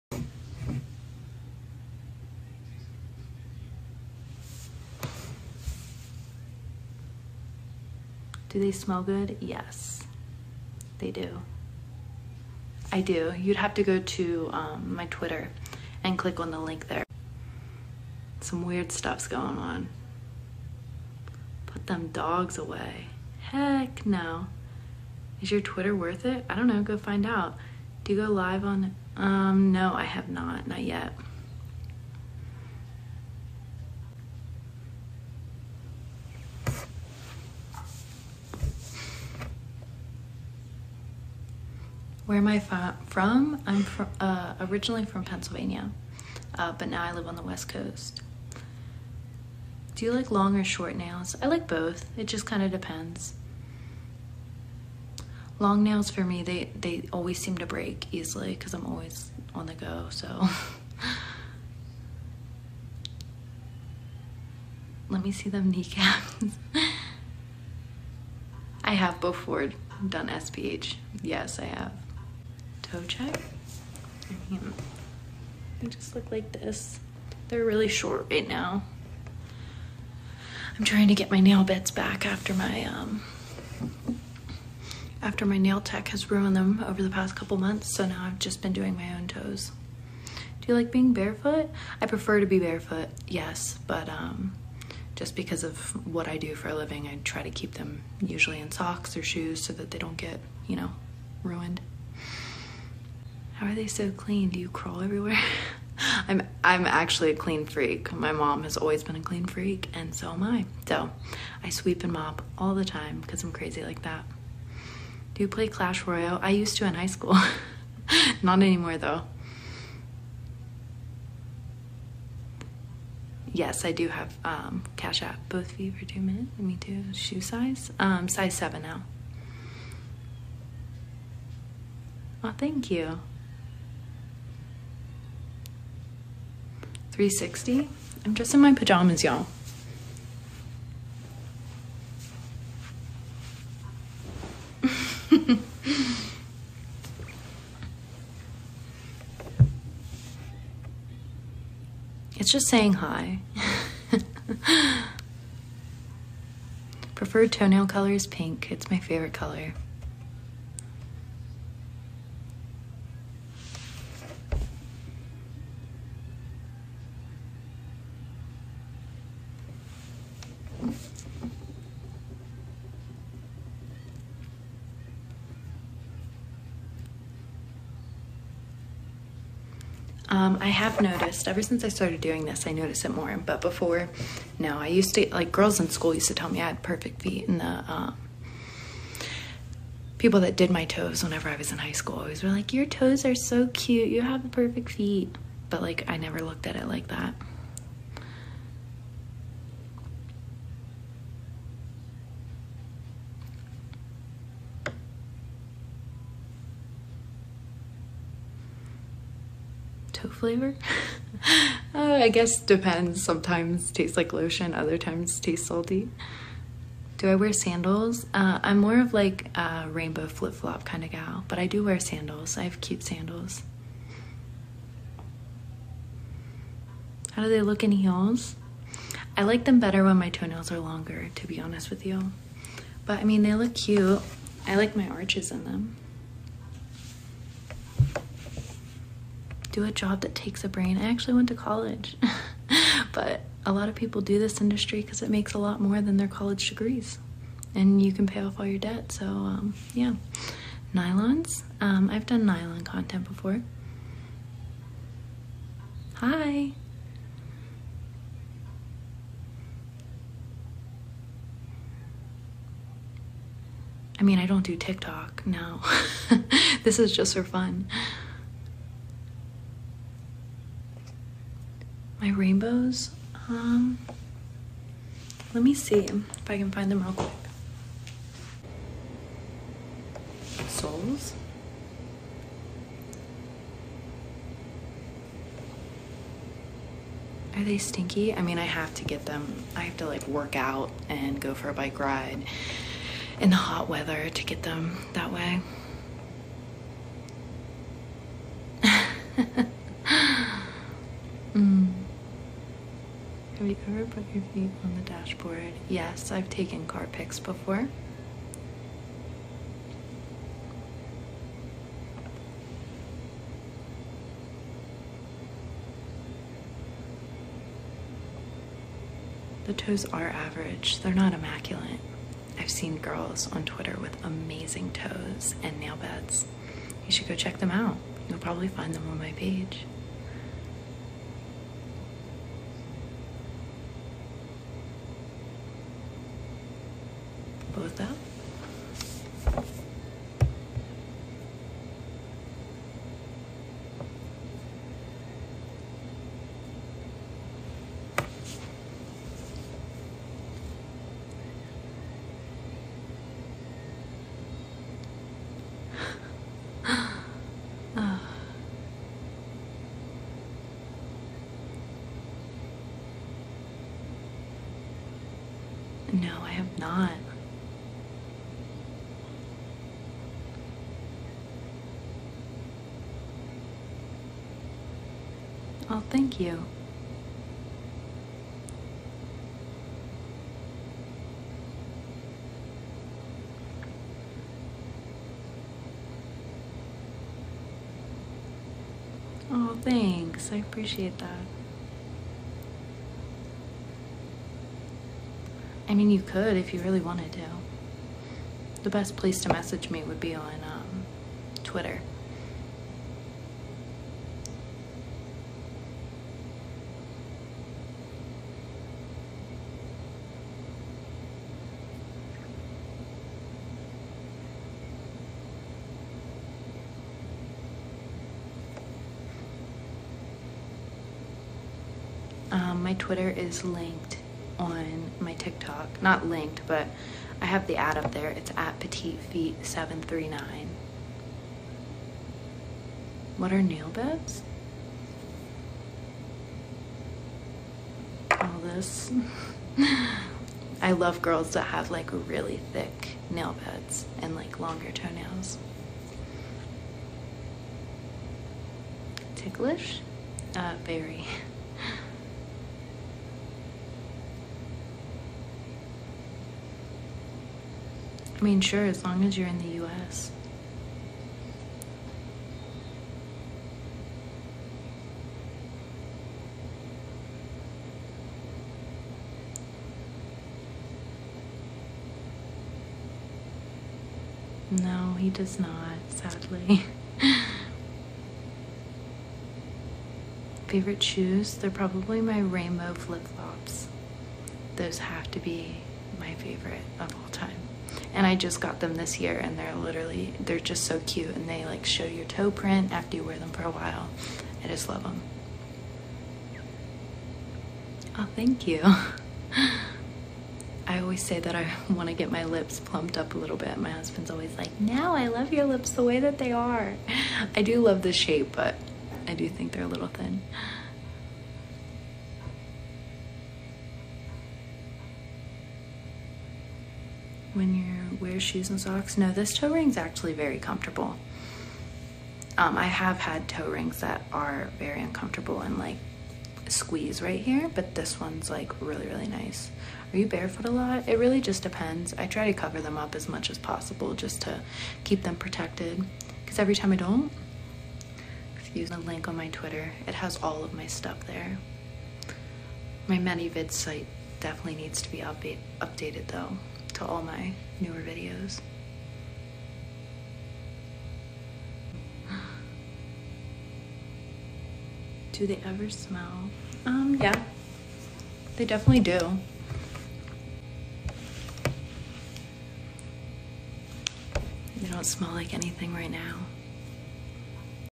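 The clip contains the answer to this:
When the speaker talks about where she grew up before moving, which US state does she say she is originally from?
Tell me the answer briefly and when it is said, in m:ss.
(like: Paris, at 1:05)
Pennsylvania, at 0:45.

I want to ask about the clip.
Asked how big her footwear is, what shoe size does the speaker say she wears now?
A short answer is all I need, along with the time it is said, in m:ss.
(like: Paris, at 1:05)
7, at 2:08.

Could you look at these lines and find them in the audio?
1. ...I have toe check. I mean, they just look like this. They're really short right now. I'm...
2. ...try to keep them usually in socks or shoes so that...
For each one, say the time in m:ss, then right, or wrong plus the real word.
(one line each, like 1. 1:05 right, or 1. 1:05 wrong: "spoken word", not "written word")
1. 1:11 right
2. 1:37 right.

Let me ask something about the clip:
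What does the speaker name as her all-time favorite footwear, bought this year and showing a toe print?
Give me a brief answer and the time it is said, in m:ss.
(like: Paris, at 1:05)
Rainbow flip flops, at 8:02.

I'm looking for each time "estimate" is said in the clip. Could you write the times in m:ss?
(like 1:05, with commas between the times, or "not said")
not said.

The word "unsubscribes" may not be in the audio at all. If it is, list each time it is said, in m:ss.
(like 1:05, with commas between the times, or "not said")
not said.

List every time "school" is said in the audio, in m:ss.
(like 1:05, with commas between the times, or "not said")
1:57, 3:05, 3:11.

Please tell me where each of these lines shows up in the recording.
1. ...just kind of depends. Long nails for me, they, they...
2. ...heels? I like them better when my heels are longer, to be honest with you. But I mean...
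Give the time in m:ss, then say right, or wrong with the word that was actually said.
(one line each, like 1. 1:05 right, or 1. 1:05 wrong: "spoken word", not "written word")
1. 0:52 right
2. 3:47 wrong: "toenails", not "heels".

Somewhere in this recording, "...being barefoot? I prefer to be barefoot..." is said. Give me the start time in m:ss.
1:30.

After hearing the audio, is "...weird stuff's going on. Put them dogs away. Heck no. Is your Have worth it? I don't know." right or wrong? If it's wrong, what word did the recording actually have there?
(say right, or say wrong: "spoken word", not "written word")
wrong: "Twitter", not "Have".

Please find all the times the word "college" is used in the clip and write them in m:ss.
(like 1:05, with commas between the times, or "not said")
4:01, 4:06.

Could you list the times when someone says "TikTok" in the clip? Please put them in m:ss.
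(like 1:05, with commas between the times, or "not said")
4:24, 7:05.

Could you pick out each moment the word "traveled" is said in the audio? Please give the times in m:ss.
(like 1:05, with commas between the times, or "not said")
not said.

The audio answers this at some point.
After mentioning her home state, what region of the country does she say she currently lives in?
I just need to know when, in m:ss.
0:47.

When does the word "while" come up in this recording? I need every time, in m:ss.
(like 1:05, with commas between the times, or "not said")
8:13.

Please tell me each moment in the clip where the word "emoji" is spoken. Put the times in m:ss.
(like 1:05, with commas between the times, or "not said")
not said.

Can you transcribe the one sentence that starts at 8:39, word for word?
No, this toe ring's actually very comfortable.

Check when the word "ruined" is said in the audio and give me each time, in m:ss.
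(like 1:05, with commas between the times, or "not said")
1:26, 1:41.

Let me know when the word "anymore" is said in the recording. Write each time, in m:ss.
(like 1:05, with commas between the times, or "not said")
1:58.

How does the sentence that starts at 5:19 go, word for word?
The toes are average, they're not immaculate.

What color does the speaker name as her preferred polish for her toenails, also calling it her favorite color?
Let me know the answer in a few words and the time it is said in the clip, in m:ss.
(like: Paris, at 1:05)
Pink, at 2:38.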